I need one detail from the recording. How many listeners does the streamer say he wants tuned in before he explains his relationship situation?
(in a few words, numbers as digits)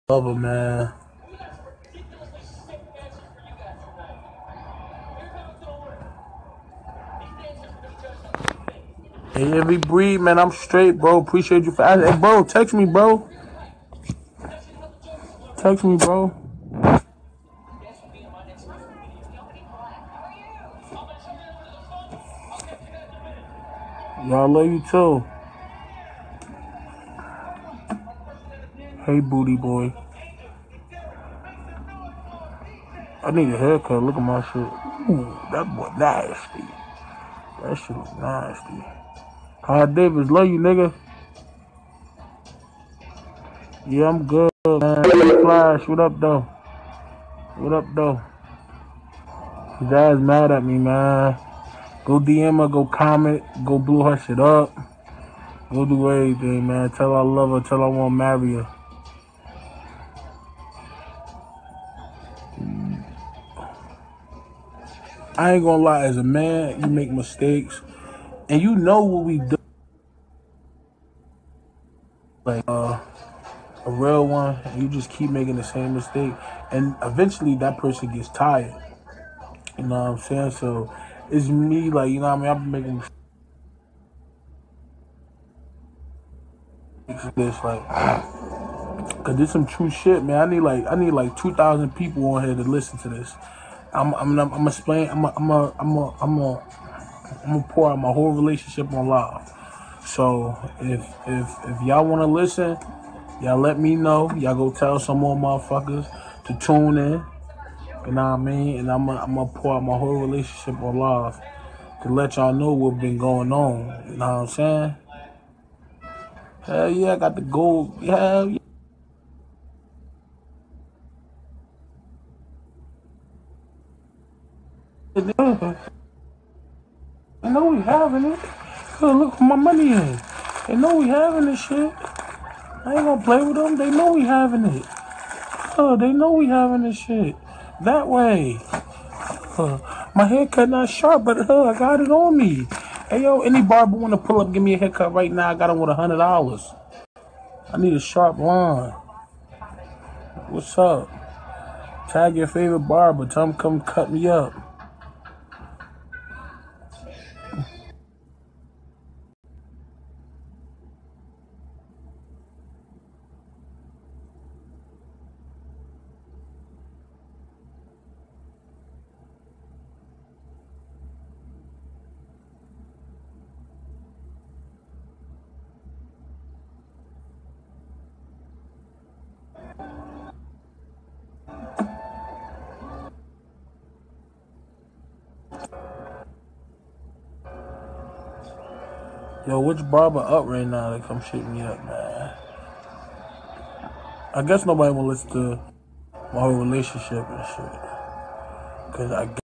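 2000.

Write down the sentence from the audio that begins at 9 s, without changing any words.
Hey, every breed, man, I'm straight, bro.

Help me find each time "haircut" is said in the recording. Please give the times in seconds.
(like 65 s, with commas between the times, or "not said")
33 s, 140 s, 144 s.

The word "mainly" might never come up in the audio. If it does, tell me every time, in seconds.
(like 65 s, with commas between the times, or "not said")
not said.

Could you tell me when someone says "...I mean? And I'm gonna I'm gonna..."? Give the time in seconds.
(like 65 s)
108 s.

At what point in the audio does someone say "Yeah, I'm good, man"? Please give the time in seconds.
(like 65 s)
43 s.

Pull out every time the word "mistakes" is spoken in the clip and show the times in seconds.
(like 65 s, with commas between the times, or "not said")
67 s, 75 s.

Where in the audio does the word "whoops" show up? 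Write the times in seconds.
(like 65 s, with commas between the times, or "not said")
not said.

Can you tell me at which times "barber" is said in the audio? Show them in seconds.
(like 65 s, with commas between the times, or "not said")
143 s, 152 s, 189 s.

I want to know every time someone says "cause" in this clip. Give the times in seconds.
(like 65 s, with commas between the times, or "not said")
89 s, 128 s, 198 s.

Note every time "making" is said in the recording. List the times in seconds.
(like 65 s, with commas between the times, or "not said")
75 s, 82 s.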